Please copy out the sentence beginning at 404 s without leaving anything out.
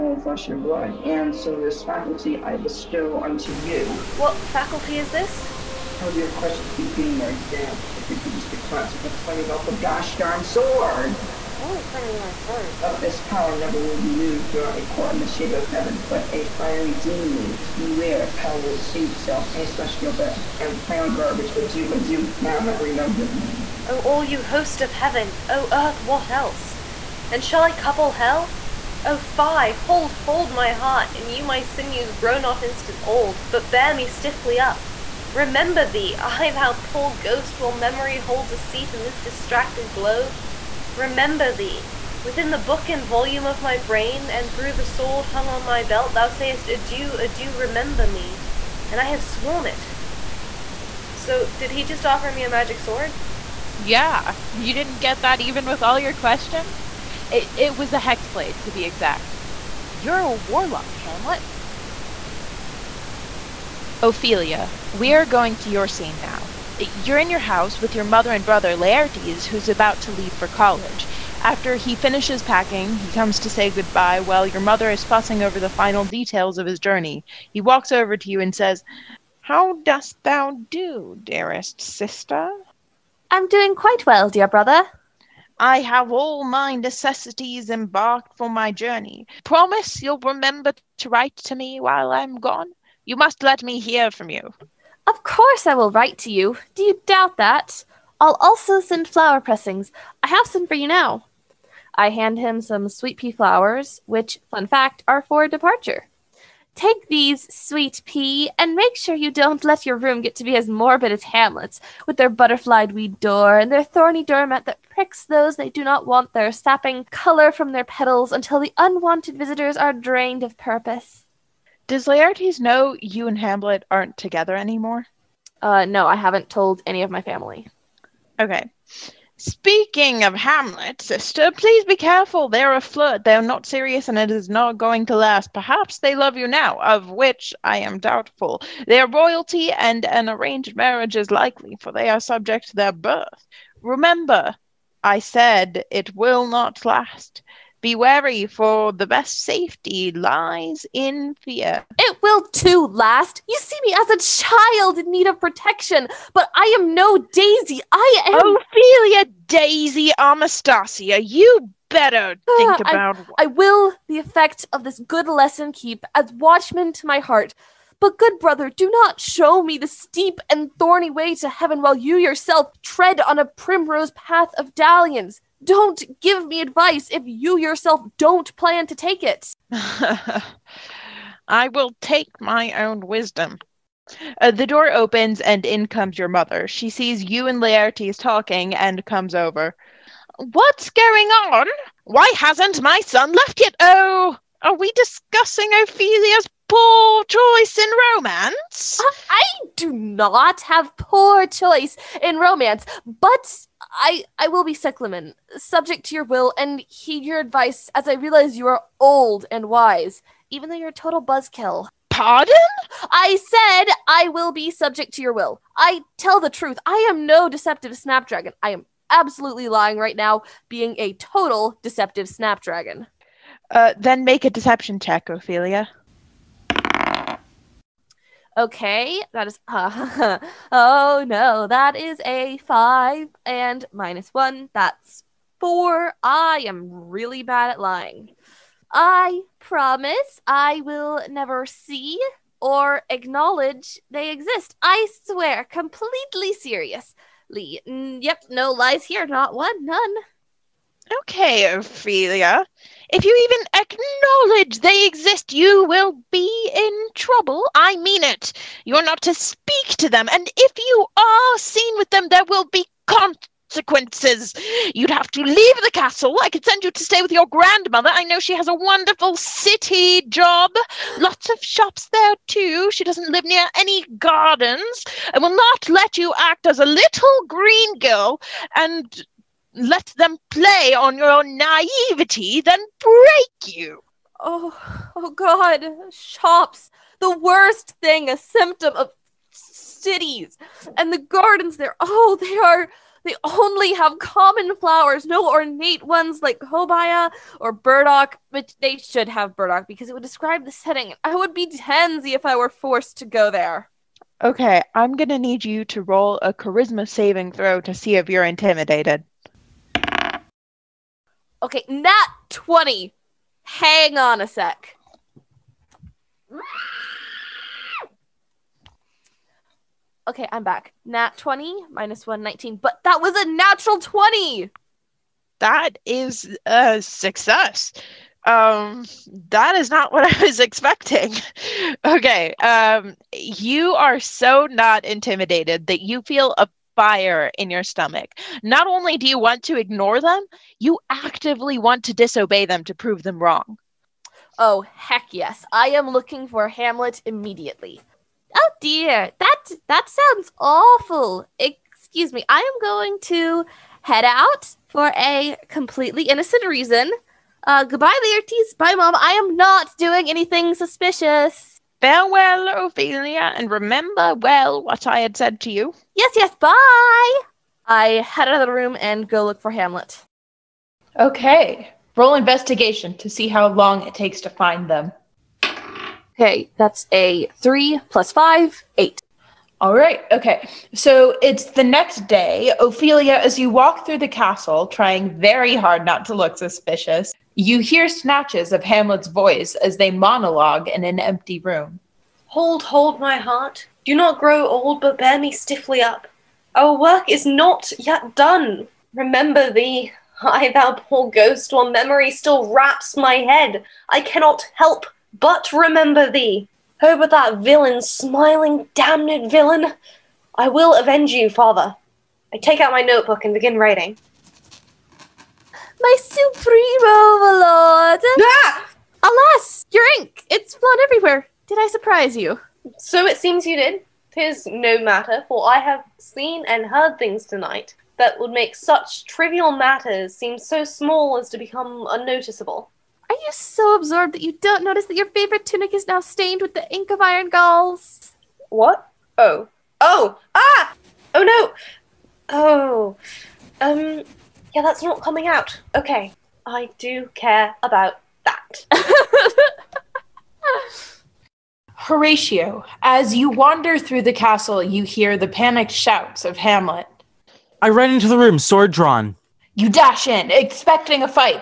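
I cannot help but remember thee.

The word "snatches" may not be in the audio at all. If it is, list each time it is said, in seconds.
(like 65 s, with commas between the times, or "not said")
388 s.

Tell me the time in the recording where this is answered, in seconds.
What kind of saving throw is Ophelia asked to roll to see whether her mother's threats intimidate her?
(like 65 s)
306 s.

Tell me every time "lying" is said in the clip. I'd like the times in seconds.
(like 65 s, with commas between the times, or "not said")
219 s, 237 s.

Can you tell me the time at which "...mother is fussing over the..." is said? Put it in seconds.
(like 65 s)
74 s.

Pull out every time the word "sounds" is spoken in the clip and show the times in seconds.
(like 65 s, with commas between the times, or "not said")
350 s.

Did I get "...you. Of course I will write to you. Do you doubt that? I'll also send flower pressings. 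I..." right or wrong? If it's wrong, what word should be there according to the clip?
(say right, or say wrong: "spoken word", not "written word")
right.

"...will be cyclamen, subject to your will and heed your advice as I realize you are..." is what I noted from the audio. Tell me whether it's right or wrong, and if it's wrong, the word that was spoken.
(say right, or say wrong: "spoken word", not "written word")
right.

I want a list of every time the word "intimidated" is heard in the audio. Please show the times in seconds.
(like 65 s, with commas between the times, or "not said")
308 s, 335 s.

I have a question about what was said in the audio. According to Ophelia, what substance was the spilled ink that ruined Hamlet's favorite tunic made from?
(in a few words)
iron galls.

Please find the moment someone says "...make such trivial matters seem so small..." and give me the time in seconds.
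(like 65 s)
428 s.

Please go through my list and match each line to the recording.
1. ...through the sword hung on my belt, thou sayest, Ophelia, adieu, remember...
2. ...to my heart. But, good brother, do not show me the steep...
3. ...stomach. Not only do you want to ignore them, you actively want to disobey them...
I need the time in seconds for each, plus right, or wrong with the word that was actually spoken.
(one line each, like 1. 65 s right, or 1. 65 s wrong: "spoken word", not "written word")
1. 44 s wrong: "Adieu", not "Ophelia"
2. 166 s right
3. 337 s right.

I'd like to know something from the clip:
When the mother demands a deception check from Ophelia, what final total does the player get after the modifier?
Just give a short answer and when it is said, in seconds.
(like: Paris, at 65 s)
4, at 234 s.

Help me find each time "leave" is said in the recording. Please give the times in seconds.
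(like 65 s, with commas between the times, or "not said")
70 s, 265 s.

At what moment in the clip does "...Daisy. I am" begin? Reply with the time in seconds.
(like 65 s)
157 s.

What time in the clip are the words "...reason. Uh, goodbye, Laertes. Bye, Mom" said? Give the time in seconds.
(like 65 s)
356 s.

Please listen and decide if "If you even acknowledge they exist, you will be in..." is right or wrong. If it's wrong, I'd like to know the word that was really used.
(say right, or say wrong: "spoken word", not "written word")
right.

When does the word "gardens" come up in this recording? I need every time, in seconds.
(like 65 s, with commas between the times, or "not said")
274 s, 291 s.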